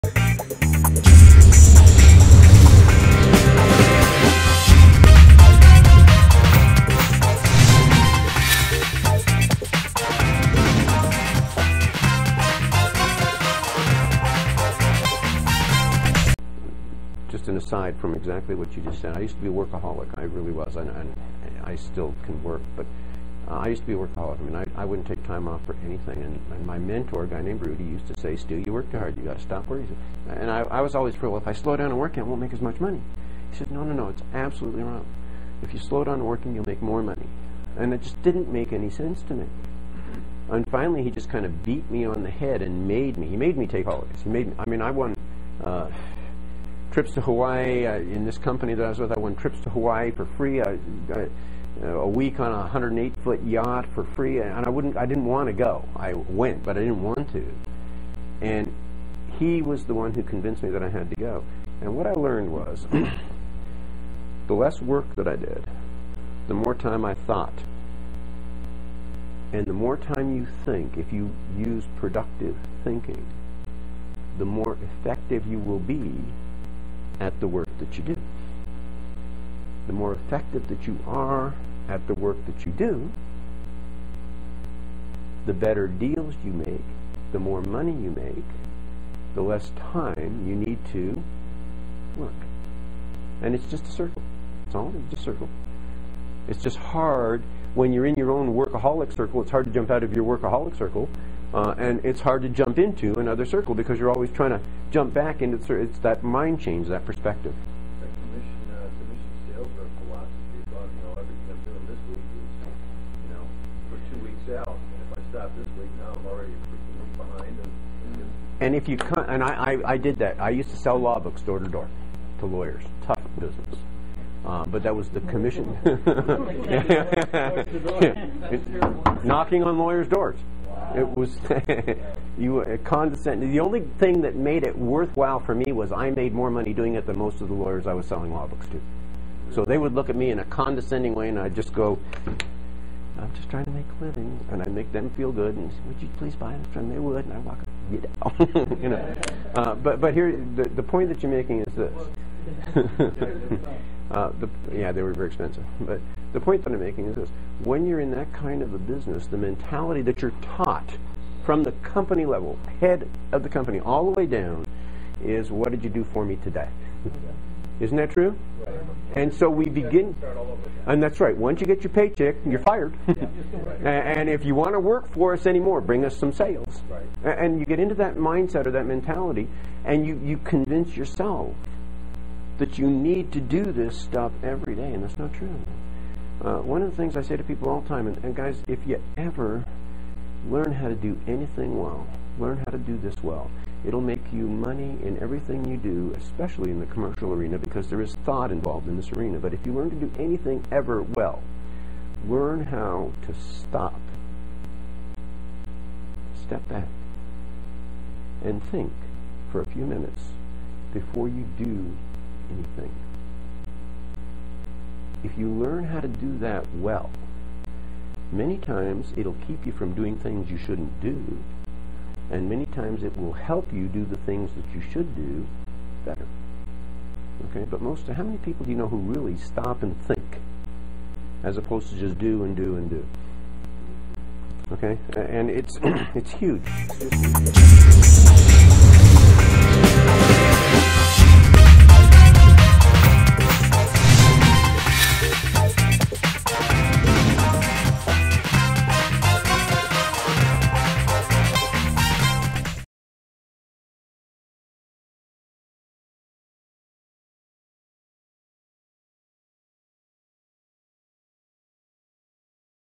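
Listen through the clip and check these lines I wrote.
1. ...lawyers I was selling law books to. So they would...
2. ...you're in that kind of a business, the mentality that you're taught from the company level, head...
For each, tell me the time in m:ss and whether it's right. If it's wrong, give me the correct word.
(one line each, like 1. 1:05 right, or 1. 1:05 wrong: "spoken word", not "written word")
1. 2:17 right
2. 2:37 right.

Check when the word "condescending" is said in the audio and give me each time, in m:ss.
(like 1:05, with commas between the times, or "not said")
2:12, 2:20.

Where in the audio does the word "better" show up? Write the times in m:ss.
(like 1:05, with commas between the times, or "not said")
1:25, 3:46.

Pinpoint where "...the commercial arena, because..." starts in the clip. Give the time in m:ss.
3:16.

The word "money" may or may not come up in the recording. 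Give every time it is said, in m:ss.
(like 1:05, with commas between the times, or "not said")
0:32, 0:37, 1:27, 2:16, 3:14.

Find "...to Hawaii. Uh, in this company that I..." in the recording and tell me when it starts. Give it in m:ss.
0:47.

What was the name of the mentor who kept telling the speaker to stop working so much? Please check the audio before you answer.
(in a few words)
Rudy.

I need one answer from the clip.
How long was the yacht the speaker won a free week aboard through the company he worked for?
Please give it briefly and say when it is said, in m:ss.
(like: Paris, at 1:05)
108 feet, at 0:52.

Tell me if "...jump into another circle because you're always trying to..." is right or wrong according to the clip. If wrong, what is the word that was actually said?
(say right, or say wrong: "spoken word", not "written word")
right.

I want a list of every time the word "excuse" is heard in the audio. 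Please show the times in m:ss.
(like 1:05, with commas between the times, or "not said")
not said.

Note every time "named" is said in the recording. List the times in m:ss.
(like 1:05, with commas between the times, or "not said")
0:27.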